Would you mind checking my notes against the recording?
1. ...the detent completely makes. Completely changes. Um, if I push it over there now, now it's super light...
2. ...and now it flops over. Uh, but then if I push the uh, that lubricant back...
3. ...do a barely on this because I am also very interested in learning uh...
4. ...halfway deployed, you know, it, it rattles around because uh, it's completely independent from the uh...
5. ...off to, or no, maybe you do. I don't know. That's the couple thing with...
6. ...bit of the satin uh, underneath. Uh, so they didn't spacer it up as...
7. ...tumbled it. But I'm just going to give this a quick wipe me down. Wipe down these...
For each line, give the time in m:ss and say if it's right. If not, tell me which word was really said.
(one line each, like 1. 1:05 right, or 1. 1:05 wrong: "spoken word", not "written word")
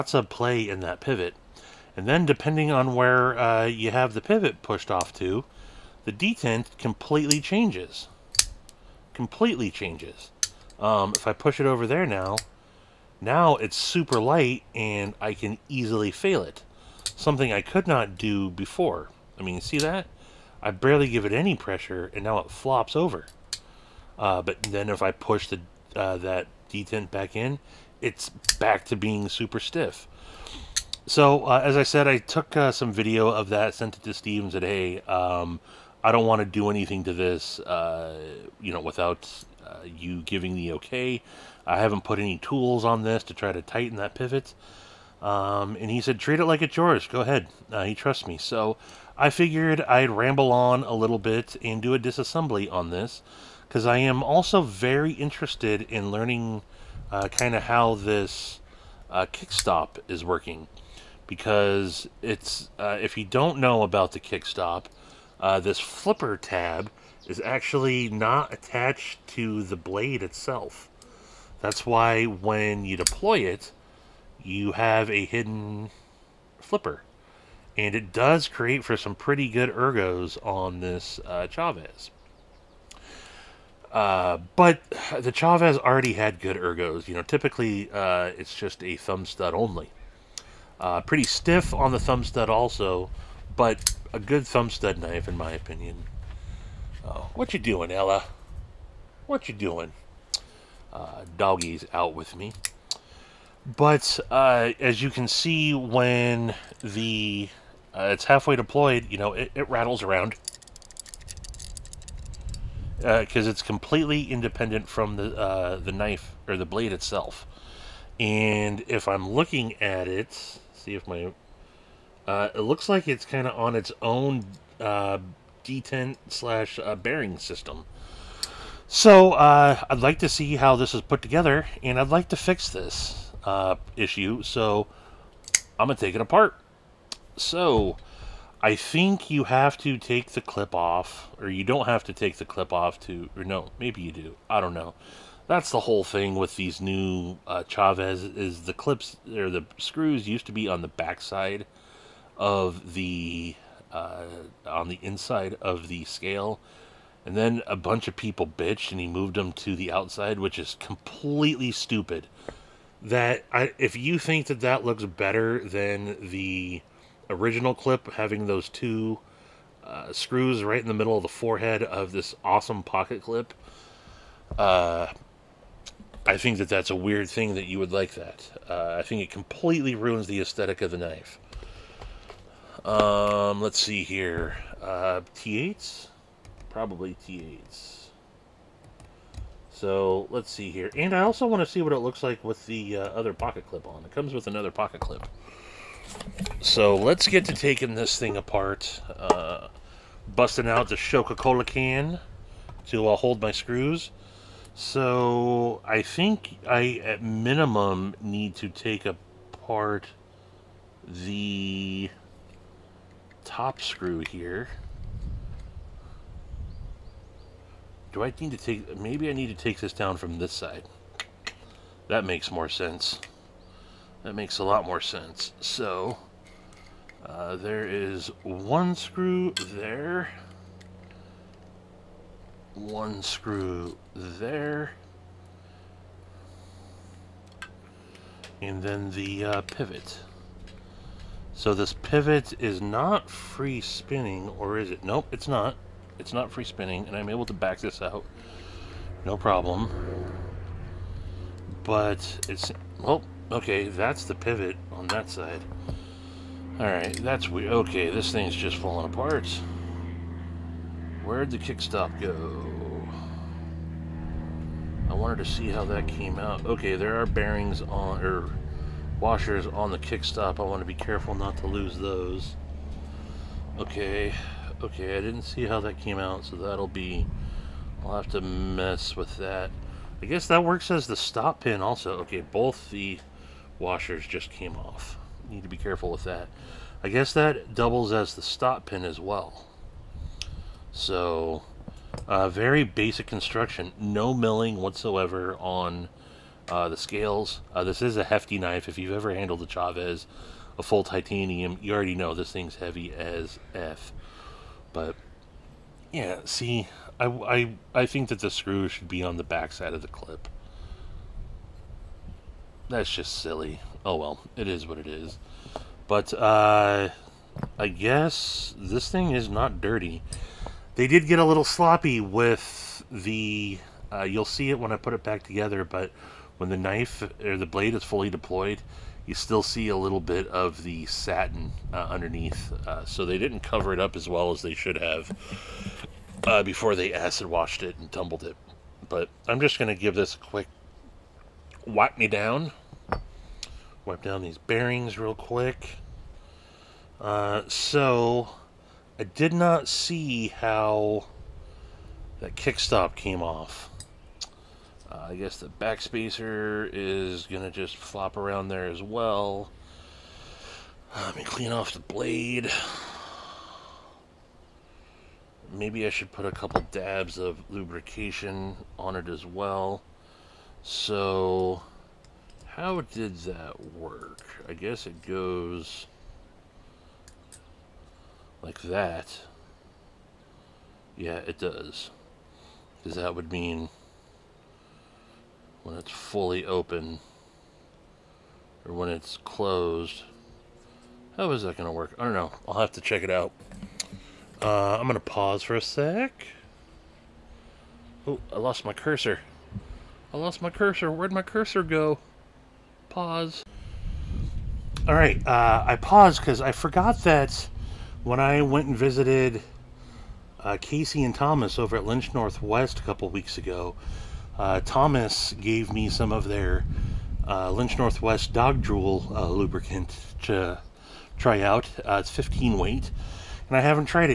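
1. 0:06 wrong: "changes", not "makes"
2. 0:22 wrong: "detent", not "lubricant"
3. 0:51 wrong: "disassembly", not "barely"
4. 1:48 right
5. 2:22 wrong: "whole", not "couple"
6. 5:30 wrong: "cover", not "spacer"
7. 5:38 right.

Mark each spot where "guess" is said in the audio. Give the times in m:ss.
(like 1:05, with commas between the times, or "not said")
4:40, 4:47, 5:17, 5:55, 6:14.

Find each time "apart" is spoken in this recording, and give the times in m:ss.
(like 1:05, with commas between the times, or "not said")
2:16, 3:18, 3:29, 4:19.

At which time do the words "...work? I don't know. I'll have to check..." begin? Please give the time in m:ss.
6:31.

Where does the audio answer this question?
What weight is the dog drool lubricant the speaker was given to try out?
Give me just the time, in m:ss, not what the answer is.
7:02.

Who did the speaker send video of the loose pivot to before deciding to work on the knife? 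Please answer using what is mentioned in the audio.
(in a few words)
Steve.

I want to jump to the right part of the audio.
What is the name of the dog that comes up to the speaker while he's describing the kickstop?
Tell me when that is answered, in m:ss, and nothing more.
1:37.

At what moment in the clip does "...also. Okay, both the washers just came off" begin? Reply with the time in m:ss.
4:41.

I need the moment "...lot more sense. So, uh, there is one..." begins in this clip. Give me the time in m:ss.
3:44.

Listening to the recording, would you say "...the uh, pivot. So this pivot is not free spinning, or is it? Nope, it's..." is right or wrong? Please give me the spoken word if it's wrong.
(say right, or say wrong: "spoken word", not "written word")
right.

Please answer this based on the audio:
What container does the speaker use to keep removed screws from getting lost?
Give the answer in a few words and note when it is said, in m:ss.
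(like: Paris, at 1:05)
Coca-Cola can, at 3:20.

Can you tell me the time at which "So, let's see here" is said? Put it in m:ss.
3:09.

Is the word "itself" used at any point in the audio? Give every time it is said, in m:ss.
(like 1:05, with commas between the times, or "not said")
1:10, 1:56.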